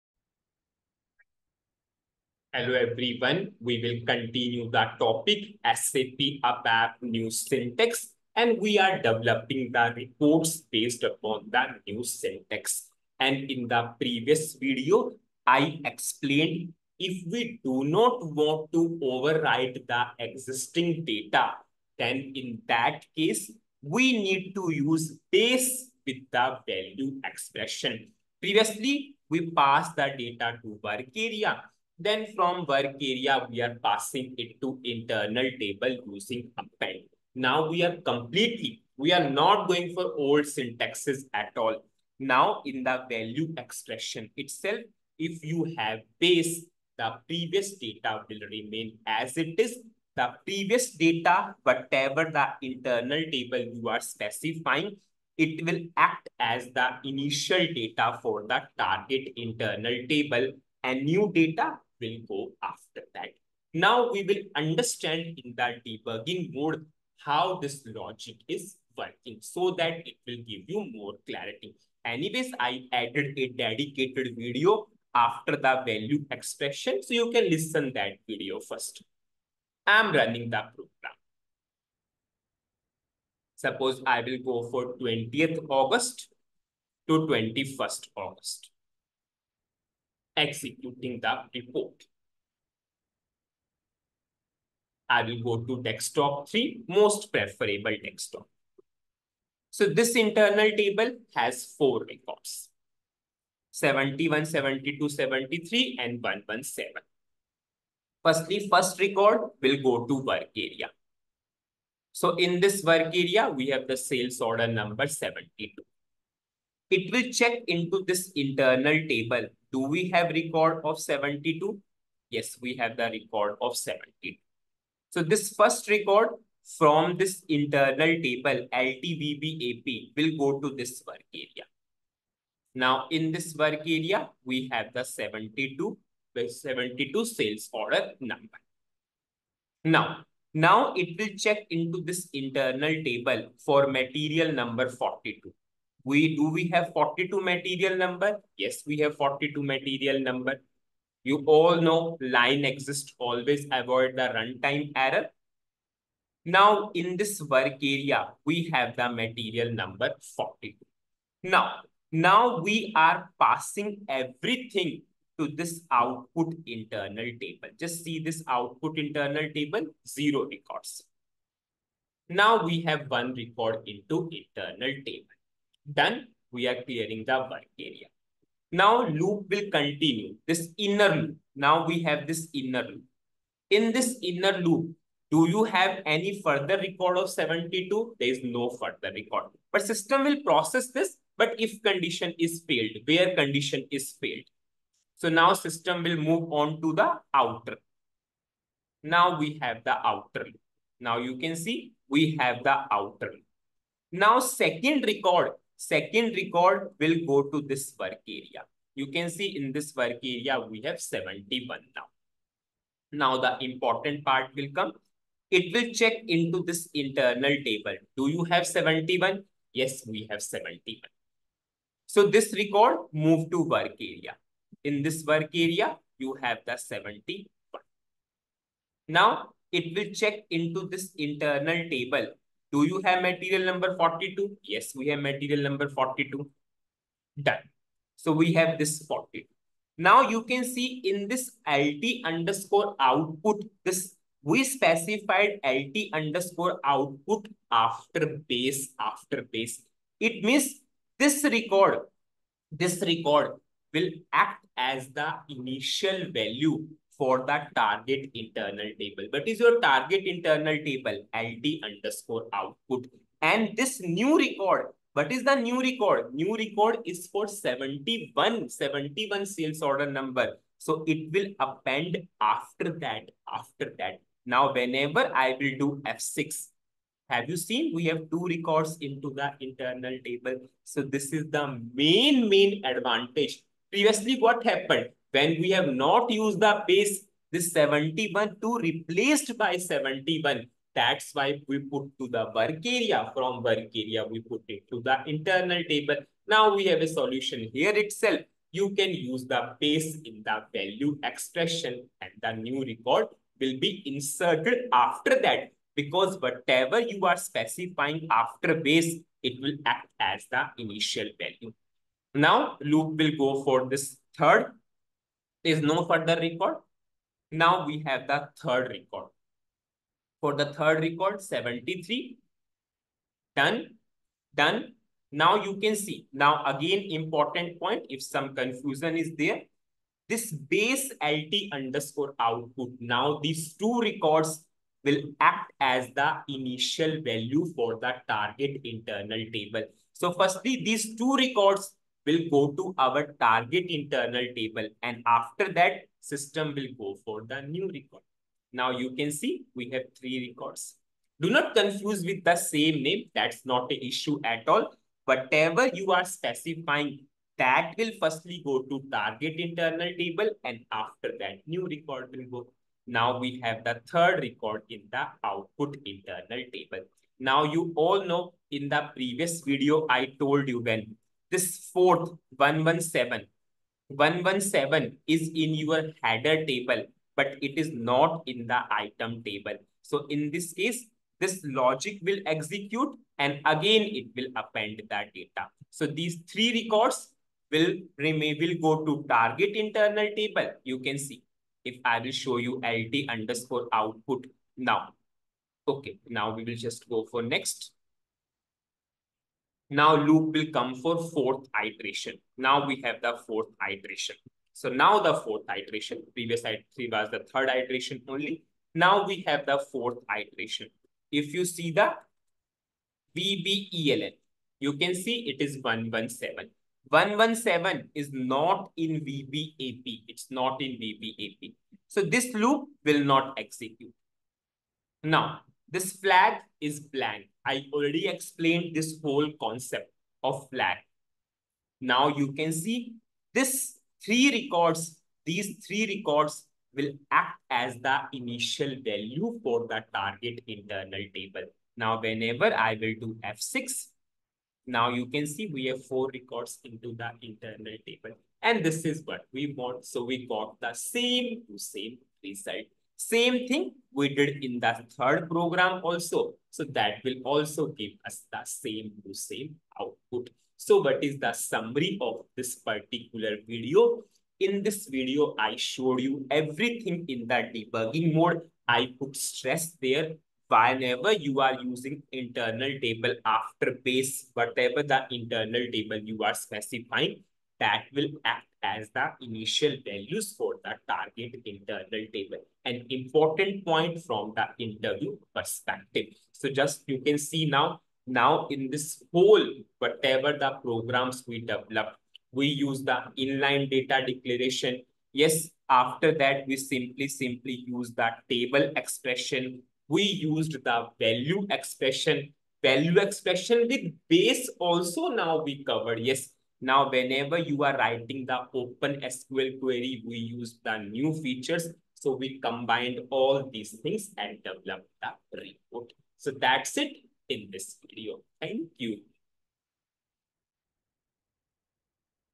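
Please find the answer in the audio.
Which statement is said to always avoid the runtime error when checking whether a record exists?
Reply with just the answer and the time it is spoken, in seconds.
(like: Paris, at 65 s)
line exists, at 152 s.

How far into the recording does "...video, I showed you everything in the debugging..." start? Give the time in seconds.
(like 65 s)
465 s.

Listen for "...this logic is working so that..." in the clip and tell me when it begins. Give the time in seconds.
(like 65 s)
67 s.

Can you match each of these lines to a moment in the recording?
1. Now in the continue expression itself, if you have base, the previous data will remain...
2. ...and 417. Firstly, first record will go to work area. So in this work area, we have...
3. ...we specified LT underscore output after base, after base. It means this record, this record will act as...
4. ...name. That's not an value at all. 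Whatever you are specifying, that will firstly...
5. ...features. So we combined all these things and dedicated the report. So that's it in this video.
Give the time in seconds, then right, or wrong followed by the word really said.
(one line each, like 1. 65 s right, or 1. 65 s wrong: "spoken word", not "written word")
1. 42 s wrong: "value", not "continue"
2. 106 s wrong: "117", not "417"
3. 244 s right
4. 353 s wrong: "issue", not "value"
5. 511 s wrong: "developed", not "dedicated".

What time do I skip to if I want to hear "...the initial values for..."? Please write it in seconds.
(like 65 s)
479 s.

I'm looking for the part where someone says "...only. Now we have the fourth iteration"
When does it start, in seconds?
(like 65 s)
408 s.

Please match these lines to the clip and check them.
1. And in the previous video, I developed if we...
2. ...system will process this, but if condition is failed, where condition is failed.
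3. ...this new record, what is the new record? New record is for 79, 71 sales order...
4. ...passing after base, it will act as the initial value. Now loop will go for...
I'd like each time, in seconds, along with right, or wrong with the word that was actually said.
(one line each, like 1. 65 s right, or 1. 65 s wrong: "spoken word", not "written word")
1. 13 s wrong: "explained", not "developed"
2. 189 s right
3. 263 s wrong: "71", not "79"
4. 307 s wrong: "specifying", not "passing".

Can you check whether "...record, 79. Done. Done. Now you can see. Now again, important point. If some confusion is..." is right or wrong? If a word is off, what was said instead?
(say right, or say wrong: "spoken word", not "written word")
wrong: "73", not "79".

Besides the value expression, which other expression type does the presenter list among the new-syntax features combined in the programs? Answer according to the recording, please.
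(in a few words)
table expression.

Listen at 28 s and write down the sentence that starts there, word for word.
Previously, we passed the data to work area then from work area, we are passing it to internal table using append.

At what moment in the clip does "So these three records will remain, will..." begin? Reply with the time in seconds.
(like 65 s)
385 s.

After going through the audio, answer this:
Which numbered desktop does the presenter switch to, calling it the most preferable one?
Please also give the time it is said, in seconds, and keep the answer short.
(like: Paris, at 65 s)
desktop 3, at 95 s.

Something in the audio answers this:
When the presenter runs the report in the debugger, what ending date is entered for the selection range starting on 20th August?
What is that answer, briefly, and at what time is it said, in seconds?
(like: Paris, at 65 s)
21st August, at 87 s.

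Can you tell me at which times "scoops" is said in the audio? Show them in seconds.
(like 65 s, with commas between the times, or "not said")
not said.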